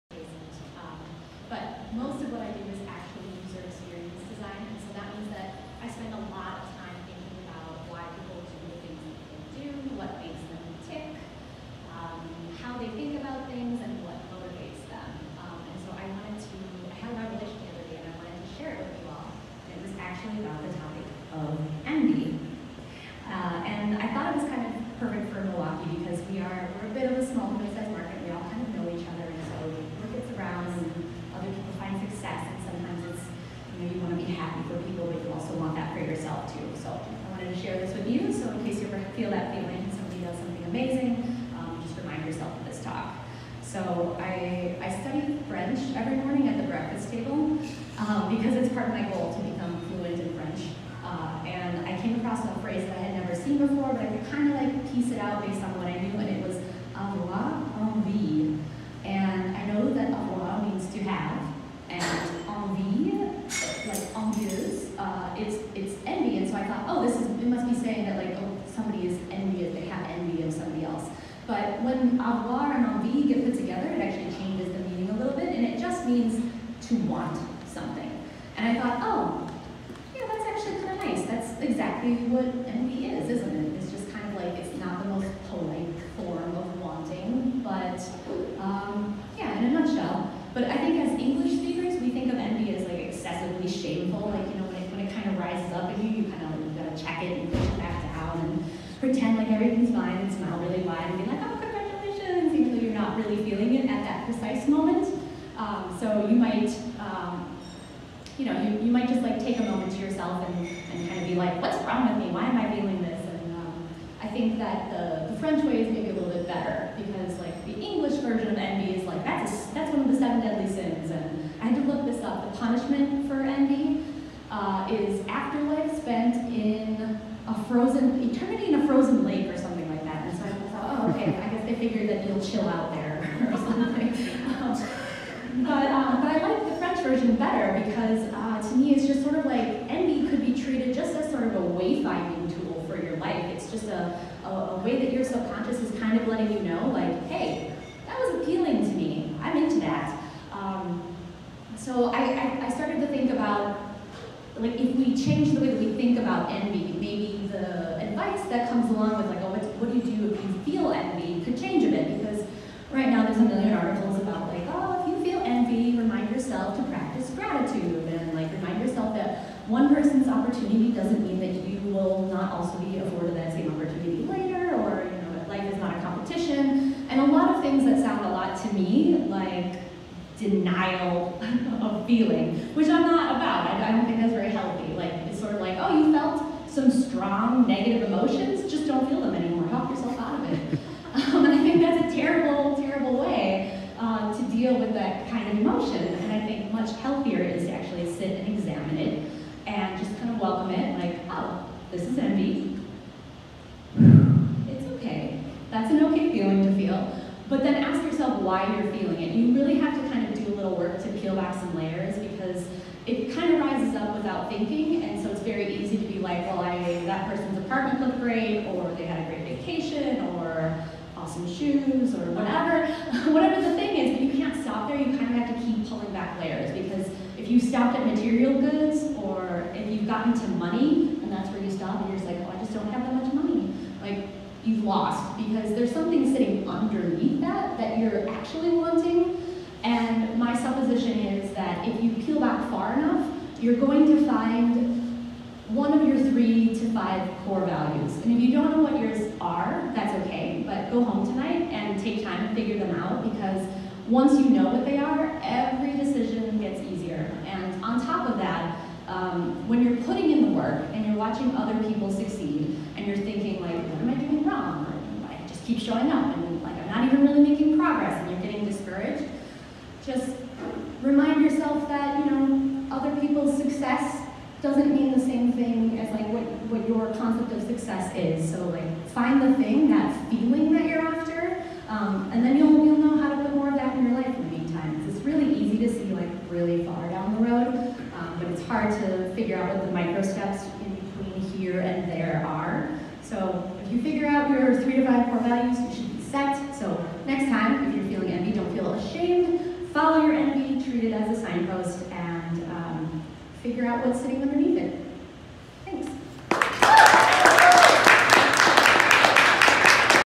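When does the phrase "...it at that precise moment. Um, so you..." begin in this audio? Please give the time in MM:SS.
01:43.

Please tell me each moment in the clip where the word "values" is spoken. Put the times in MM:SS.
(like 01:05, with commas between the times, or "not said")
04:07, 04:55.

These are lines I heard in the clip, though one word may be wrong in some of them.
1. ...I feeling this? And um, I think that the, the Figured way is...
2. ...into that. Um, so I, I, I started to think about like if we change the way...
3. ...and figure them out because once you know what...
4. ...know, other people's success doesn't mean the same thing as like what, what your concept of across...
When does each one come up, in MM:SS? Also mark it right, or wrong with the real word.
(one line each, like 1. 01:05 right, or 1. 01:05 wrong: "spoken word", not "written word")
1. 01:52 wrong: "French", not "Figured"
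2. 02:29 right
3. 04:12 right
4. 04:32 wrong: "success", not "across".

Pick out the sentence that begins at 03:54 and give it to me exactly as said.
Like, you've lost because there's something sitting underneath that that you're actually wanting.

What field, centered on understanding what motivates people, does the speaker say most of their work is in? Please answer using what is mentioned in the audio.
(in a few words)
User experience design.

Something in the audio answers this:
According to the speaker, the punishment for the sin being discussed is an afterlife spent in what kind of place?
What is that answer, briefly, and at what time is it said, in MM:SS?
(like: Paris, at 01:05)
Frozen, at 02:07.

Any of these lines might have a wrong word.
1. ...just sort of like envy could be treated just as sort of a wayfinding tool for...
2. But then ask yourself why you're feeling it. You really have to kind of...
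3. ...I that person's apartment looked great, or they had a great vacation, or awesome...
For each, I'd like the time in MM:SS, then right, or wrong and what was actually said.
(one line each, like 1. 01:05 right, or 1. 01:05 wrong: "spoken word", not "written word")
1. 02:19 right
2. 03:27 right
3. 03:36 right.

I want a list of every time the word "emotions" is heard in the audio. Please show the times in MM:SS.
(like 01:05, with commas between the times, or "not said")
03:08, 03:15.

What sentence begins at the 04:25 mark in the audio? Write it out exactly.
Or, I just keep showing up and like I'm not even really making progress and you're getting discouraged.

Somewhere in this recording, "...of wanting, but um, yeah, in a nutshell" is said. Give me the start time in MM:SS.
01:26.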